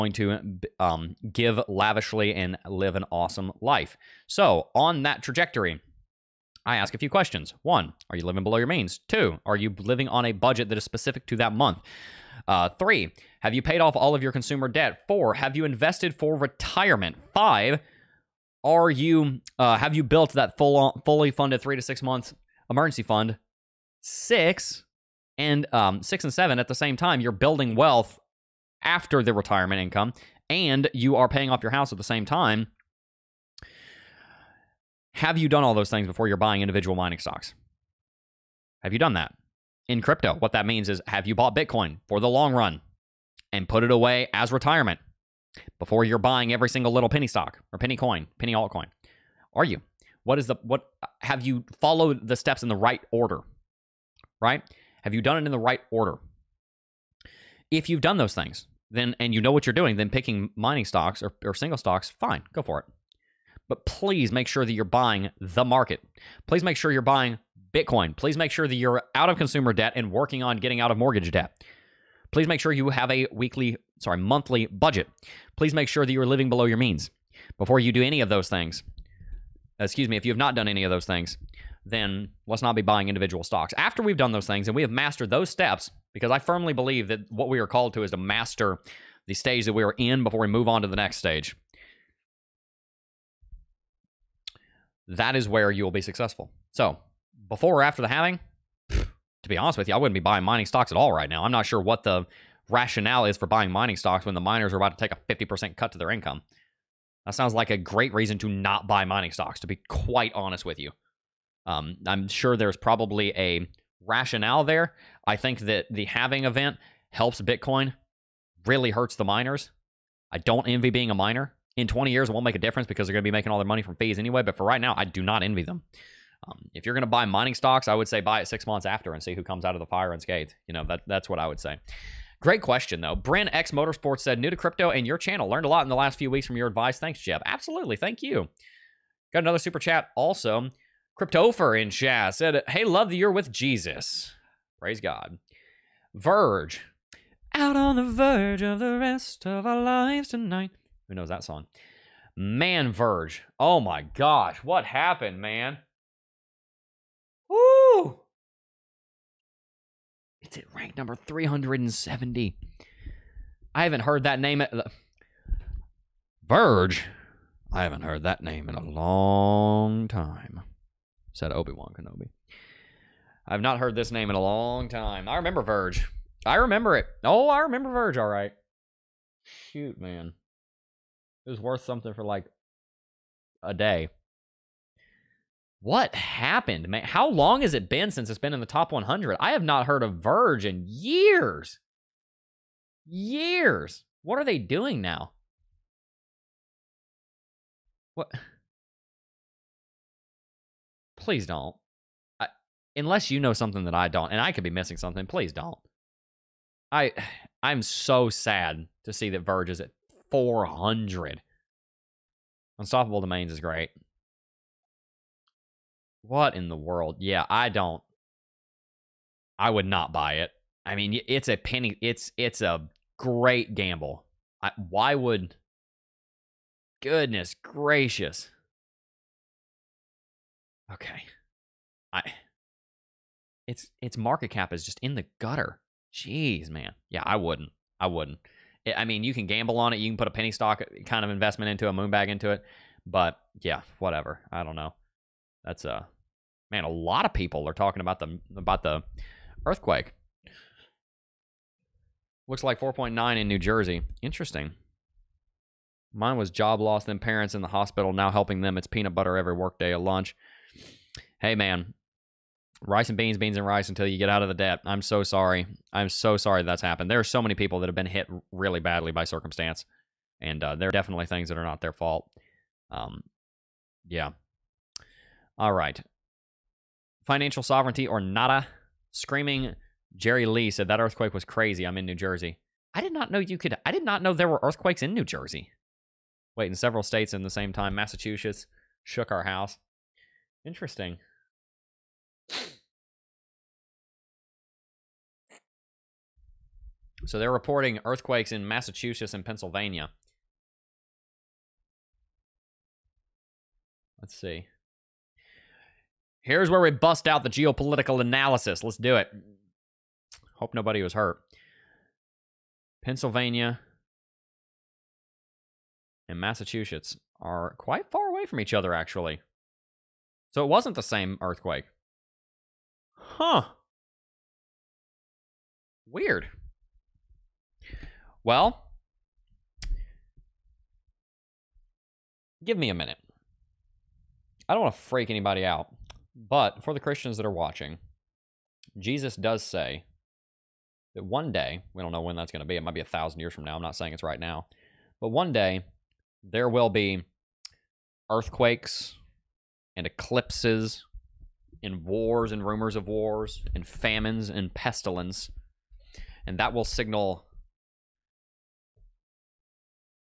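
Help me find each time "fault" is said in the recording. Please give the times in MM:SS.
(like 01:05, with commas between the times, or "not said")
04:31.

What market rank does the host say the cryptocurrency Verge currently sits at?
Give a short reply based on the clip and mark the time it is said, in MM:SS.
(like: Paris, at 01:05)
370, at 02:41.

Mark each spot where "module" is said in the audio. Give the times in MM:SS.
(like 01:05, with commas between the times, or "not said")
not said.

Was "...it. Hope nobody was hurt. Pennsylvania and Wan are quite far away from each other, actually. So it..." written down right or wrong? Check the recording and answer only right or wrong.
wrong.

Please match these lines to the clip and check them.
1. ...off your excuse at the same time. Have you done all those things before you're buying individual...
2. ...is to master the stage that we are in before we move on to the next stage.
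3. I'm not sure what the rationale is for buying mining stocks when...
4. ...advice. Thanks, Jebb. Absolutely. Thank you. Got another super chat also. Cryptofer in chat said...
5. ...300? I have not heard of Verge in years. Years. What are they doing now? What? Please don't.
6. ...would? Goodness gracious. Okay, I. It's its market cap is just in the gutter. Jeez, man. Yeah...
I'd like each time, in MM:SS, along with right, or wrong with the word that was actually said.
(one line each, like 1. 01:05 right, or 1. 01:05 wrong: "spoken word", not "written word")
1. 00:31 wrong: "house", not "excuse"
2. 01:28 right
3. 01:41 right
4. 02:16 right
5. 03:08 wrong: "100", not "300"
6. 03:45 right.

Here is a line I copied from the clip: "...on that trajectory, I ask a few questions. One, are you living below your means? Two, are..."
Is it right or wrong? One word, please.
right.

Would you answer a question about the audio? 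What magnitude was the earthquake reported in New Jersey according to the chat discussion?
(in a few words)
4.9.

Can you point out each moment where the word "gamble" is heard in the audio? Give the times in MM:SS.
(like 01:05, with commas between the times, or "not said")
03:43, 03:59.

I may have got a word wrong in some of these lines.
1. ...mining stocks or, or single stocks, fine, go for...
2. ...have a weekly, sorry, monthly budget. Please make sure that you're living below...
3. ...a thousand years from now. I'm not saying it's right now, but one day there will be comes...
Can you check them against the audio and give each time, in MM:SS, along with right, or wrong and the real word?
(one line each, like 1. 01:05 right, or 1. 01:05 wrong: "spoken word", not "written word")
1. 01:00 right
2. 01:12 right
3. 05:43 wrong: "earthquakes", not "comes".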